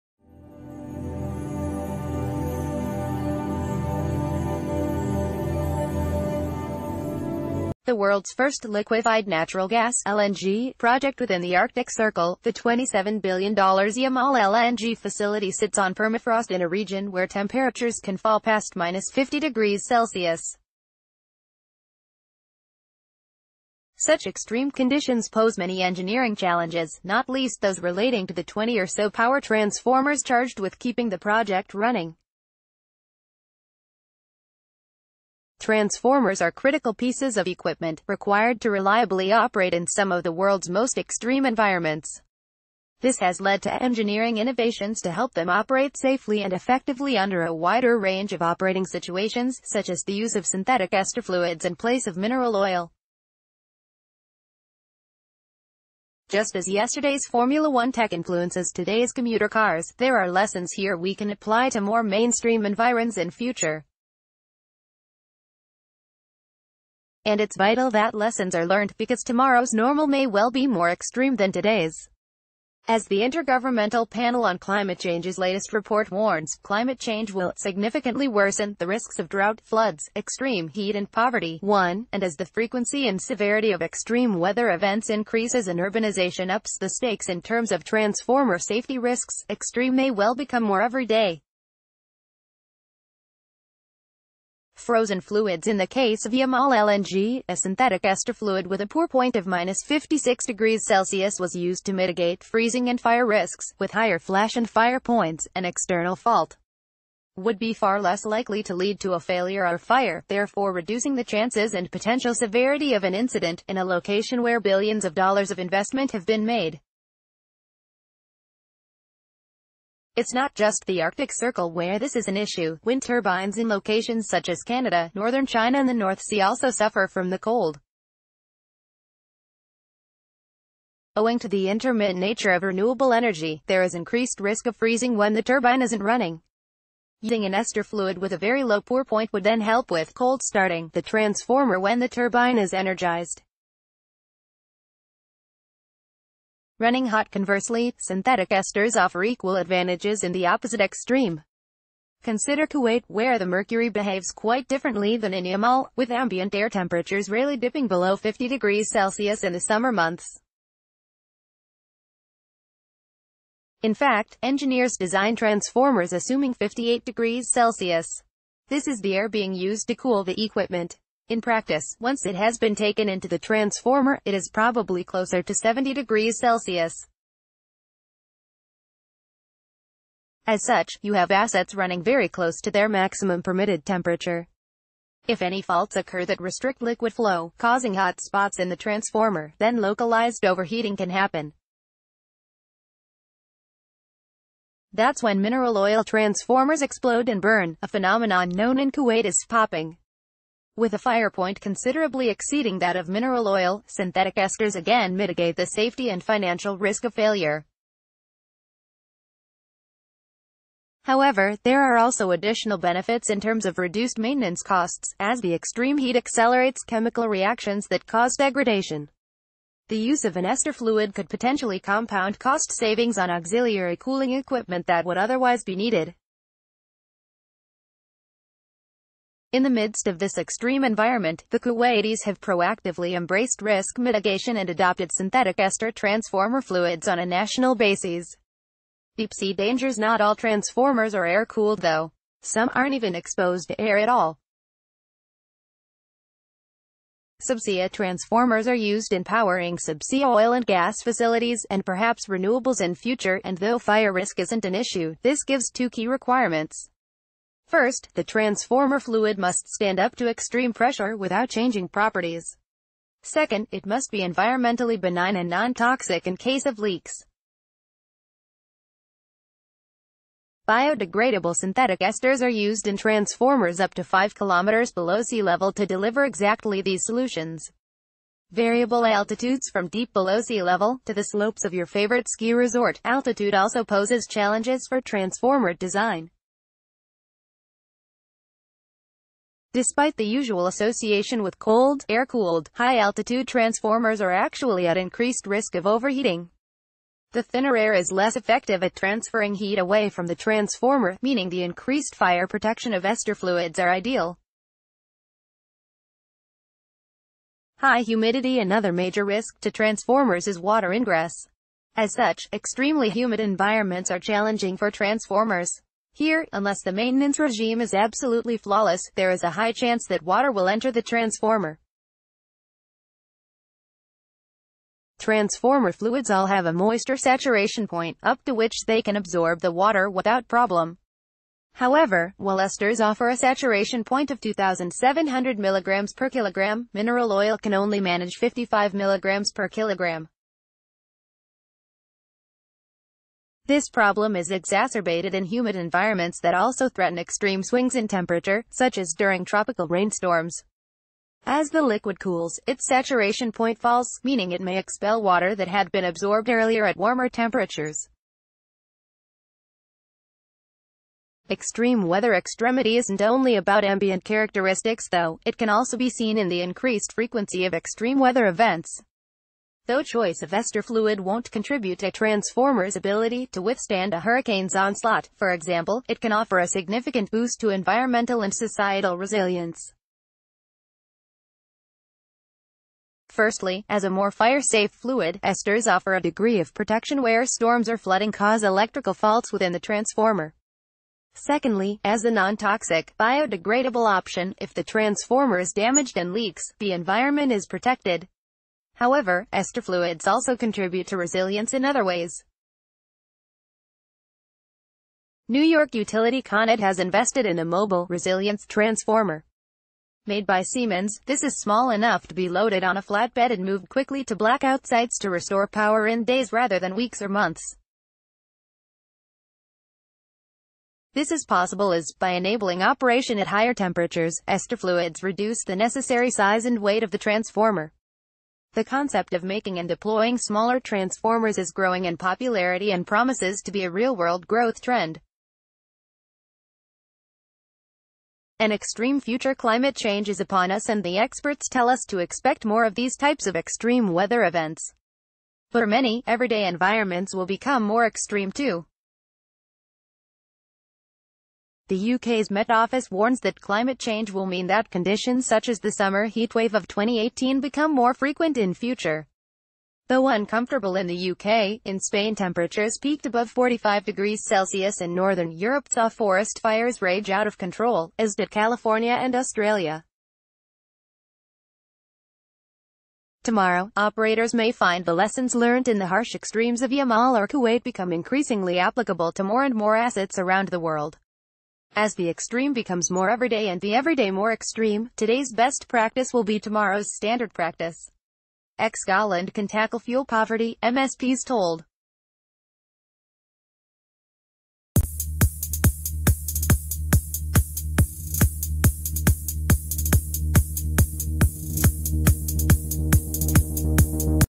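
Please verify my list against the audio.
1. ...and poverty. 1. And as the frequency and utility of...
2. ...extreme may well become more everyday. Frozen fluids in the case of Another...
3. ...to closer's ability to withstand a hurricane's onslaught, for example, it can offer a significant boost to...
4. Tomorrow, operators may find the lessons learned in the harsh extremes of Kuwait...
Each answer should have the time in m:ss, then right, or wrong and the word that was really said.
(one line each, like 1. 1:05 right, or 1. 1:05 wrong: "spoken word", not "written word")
1. 1:20 wrong: "severity", not "utility"
2. 1:29 wrong: "Yamal", not "Another"
3. 6:11 wrong: "transformer", not "closer"
4. 7:53 wrong: "Yamal", not "Kuwait".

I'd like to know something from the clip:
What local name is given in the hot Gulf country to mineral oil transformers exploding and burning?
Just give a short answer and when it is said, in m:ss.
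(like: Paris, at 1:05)
popping, at 3:19.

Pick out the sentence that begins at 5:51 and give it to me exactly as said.
As the liquid cools, its saturation point falls, meaning it may expel water that had been absorbed earlier at warmer temperatures.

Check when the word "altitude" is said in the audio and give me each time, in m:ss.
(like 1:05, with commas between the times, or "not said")
4:39, 4:43, 4:52.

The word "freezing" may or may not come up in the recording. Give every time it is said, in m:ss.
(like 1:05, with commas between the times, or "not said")
1:42, 2:14.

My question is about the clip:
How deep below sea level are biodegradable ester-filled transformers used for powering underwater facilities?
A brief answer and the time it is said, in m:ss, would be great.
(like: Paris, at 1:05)
5 km, at 4:34.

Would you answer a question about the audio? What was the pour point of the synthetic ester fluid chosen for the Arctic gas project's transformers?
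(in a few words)
-56°C.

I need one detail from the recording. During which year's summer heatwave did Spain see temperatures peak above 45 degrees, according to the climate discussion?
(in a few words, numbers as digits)
2018.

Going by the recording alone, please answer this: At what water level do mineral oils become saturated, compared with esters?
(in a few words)
55 mg per kilogram.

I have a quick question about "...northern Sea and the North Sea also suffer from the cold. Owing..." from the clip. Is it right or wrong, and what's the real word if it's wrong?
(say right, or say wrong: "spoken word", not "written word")
wrong: "China", not "Sea".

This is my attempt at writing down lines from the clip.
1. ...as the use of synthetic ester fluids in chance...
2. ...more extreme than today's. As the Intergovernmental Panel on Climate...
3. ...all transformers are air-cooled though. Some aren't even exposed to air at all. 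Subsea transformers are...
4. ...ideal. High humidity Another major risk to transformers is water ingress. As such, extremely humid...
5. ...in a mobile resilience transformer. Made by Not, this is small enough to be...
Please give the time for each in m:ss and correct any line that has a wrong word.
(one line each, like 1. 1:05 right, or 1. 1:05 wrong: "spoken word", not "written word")
1. 0:49 wrong: "place", not "chance"
2. 1:10 right
3. 4:00 right
4. 5:03 right
5. 6:47 wrong: "Siemens", not "Not".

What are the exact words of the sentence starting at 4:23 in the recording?
Second, it must be environmentally benign and non-toxic in case of leaks.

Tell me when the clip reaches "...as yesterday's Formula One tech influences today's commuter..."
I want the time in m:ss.
0:56.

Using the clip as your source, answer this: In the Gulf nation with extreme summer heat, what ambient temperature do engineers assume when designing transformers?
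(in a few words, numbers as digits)
58°C.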